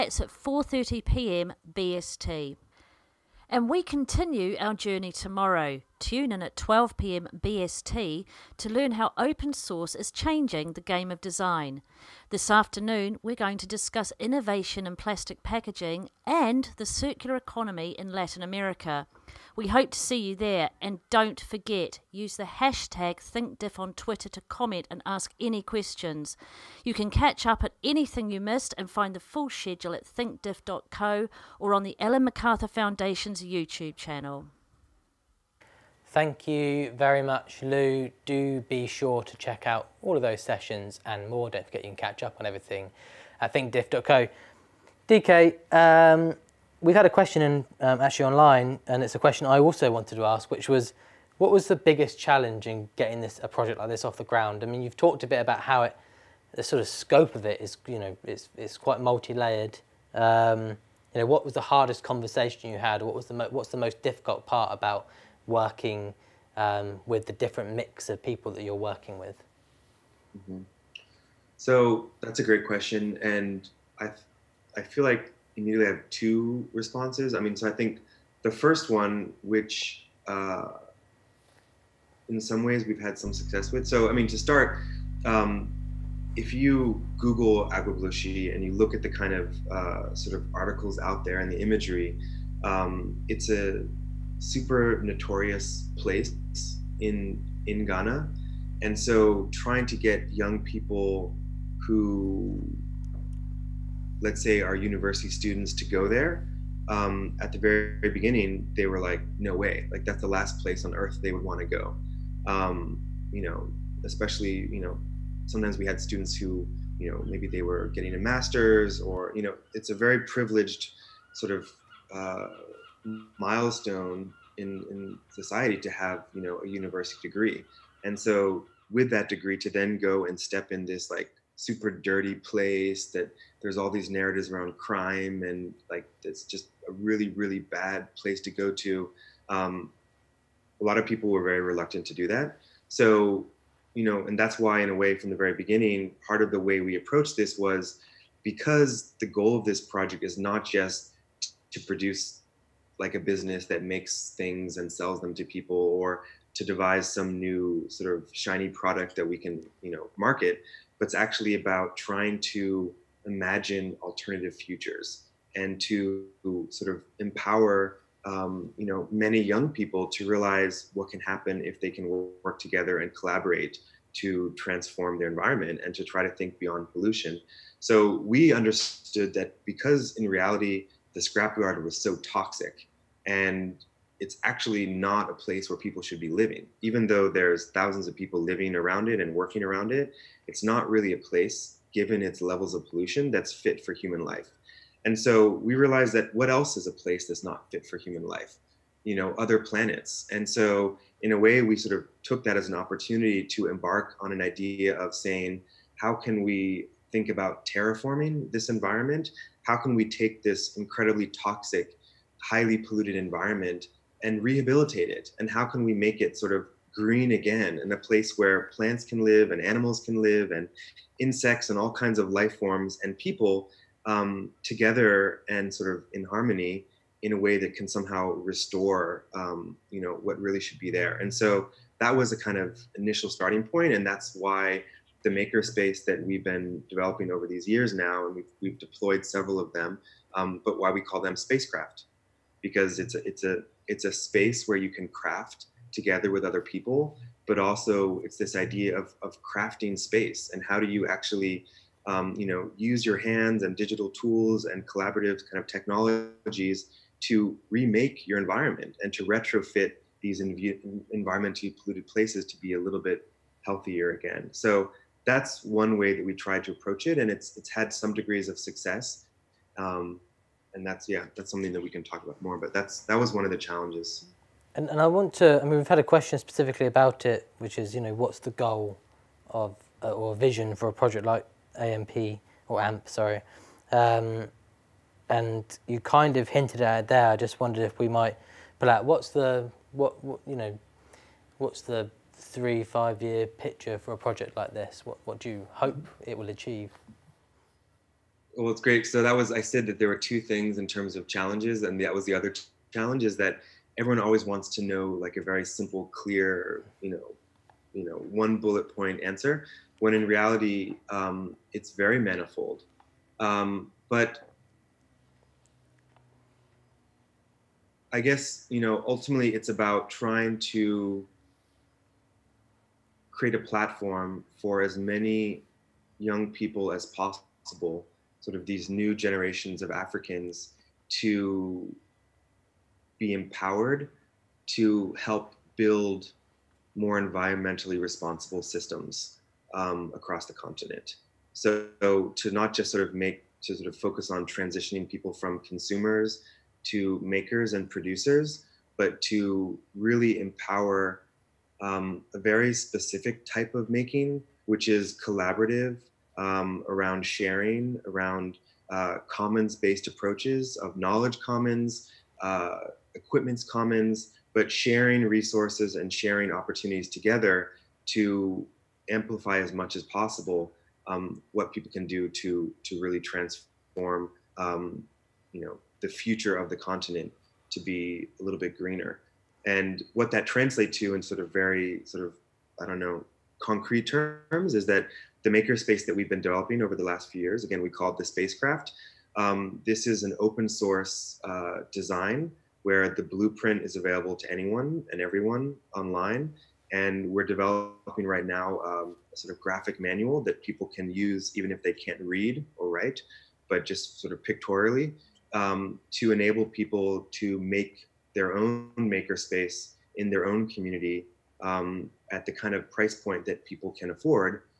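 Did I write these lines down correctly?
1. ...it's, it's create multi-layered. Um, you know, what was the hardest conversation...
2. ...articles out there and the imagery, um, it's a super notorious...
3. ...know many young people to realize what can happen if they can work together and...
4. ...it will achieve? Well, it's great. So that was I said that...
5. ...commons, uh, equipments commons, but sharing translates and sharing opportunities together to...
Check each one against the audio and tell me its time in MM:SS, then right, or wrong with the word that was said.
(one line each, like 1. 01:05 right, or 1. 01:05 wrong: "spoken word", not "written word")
1. 00:58 wrong: "quite", not "create"
2. 01:30 right
3. 02:48 right
4. 04:56 right
5. 06:01 wrong: "resources", not "translates".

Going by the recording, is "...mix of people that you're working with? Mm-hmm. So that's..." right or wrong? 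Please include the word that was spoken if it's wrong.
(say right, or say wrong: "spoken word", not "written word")
right.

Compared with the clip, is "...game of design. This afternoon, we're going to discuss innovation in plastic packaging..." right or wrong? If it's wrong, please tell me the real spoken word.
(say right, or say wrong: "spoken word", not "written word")
right.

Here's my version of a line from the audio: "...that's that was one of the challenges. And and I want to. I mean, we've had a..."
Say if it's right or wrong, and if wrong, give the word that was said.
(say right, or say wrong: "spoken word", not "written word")
right.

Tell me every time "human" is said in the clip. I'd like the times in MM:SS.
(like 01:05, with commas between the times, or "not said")
03:13, 03:17.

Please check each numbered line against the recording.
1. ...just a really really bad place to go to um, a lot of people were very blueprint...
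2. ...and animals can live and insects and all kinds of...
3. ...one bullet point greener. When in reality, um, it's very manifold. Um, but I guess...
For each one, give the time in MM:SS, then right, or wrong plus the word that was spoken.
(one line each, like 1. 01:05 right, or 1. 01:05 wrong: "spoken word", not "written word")
1. 02:16 wrong: "reluctant", not "blueprint"
2. 03:39 right
3. 05:08 wrong: "answer", not "greener".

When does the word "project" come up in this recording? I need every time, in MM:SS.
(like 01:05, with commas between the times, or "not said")
00:53, 02:29, 04:40, 04:54.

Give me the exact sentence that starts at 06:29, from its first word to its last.
Um, this is an open source uh, design where the blueprint is available to anyone and everyone online.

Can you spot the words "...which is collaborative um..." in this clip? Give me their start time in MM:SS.
05:54.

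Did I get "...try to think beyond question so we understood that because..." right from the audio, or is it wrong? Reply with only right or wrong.
wrong.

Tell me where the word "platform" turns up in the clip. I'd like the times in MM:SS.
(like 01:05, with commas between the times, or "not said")
05:23.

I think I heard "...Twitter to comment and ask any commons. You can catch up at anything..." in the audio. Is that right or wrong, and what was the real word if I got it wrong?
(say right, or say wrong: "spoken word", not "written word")
wrong: "questions", not "commons".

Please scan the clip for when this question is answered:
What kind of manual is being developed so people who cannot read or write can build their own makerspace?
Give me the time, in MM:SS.
06:39.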